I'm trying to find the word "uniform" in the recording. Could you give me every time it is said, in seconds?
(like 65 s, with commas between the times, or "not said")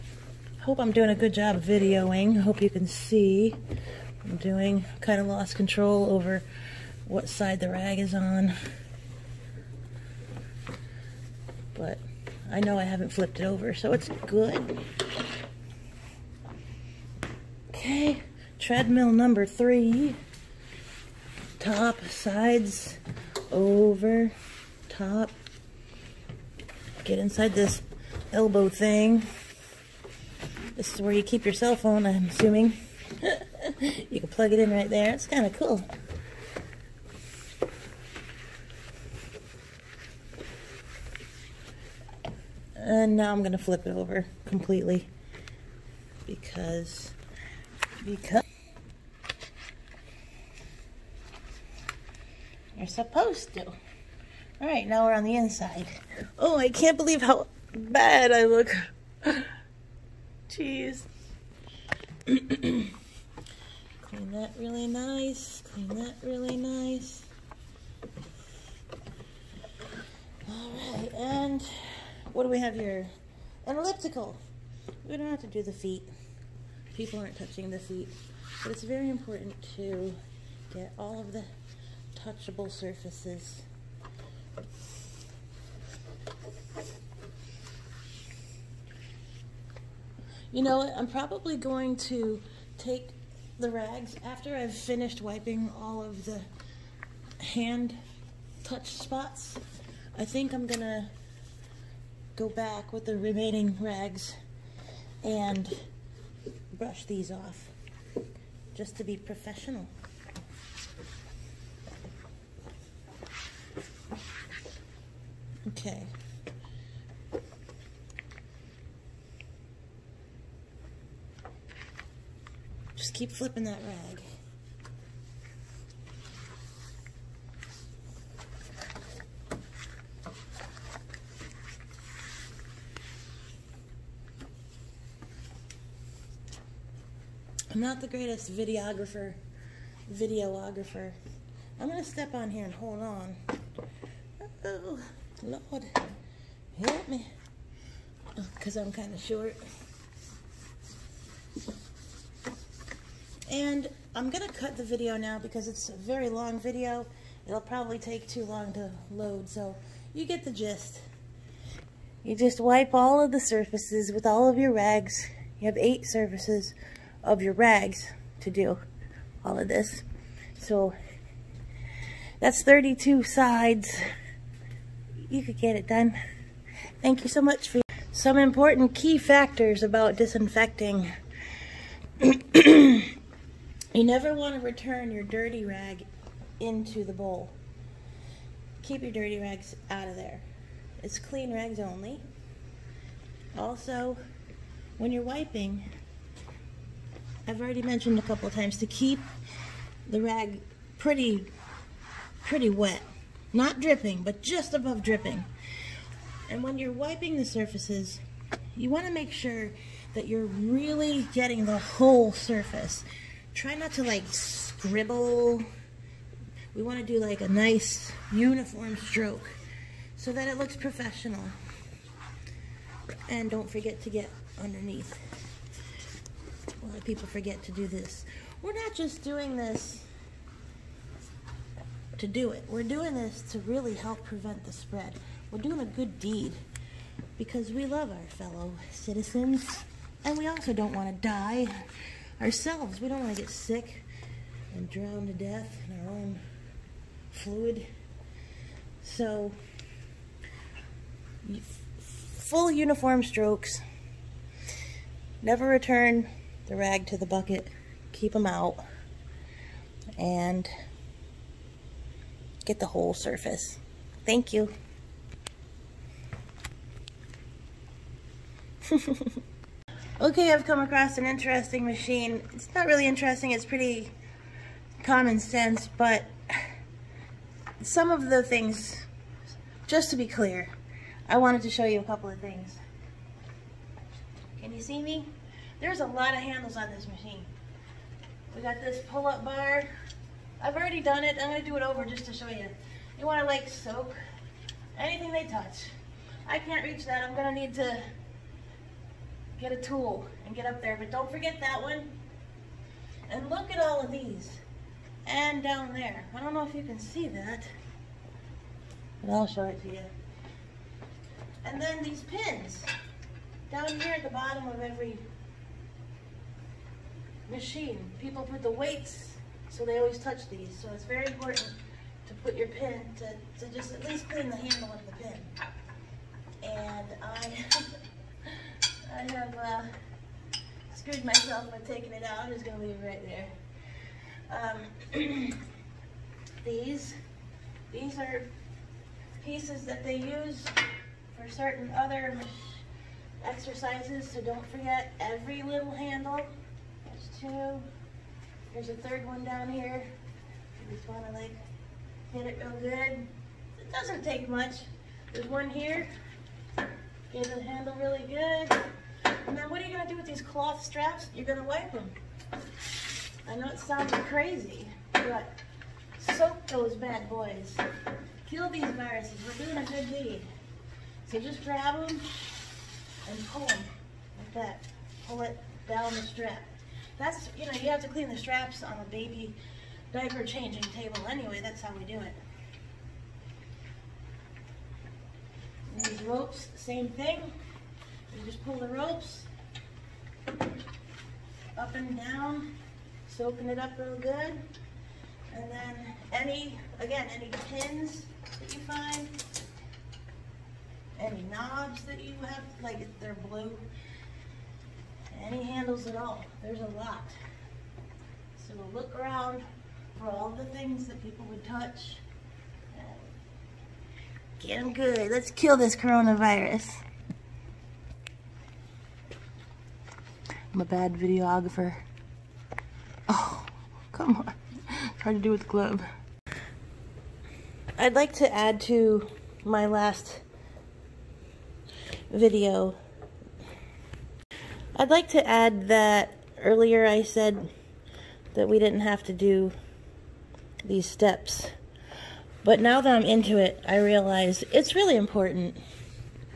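218 s, 252 s.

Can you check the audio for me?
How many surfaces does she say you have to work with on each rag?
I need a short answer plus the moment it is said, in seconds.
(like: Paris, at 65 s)
8, at 165 s.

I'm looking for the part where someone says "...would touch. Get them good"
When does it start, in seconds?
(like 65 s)
411 s.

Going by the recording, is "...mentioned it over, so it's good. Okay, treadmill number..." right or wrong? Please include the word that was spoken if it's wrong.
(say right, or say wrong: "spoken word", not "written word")
wrong: "flipped", not "mentioned".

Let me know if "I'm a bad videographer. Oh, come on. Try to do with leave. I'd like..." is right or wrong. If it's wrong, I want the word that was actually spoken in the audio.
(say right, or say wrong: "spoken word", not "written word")
wrong: "glove", not "leave".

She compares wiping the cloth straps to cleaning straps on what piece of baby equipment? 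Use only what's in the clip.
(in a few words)
Diaper changing table.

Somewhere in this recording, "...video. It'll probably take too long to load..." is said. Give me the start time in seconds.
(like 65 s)
156 s.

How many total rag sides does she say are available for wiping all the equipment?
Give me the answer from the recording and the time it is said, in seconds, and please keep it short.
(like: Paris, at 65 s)
32, at 172 s.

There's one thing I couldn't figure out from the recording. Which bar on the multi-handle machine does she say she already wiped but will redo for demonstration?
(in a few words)
Pull-up bar.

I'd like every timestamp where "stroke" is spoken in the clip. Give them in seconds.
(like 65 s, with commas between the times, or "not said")
218 s, 253 s.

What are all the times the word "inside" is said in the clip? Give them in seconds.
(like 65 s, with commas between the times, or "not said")
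27 s, 55 s.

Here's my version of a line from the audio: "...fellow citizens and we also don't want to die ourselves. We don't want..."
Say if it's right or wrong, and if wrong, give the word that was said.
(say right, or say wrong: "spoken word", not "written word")
right.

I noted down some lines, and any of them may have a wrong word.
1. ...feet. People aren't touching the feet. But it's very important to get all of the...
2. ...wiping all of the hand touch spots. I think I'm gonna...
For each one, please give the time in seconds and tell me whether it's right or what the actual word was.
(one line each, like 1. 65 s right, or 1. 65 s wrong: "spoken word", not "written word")
1. 75 s right
2. 95 s right.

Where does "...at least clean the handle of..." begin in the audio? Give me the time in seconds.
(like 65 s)
323 s.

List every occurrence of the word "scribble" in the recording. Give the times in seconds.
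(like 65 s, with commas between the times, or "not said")
214 s.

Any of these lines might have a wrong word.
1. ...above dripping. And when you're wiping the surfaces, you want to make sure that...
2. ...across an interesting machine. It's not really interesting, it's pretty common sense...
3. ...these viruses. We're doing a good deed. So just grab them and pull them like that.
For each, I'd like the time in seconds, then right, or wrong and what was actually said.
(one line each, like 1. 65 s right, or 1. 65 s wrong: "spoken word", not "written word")
1. 204 s right
2. 270 s right
3. 368 s right.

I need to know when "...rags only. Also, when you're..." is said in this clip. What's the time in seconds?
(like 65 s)
191 s.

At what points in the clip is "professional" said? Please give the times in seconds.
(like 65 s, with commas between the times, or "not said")
109 s, 220 s.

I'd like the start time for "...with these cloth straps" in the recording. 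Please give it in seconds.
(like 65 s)
360 s.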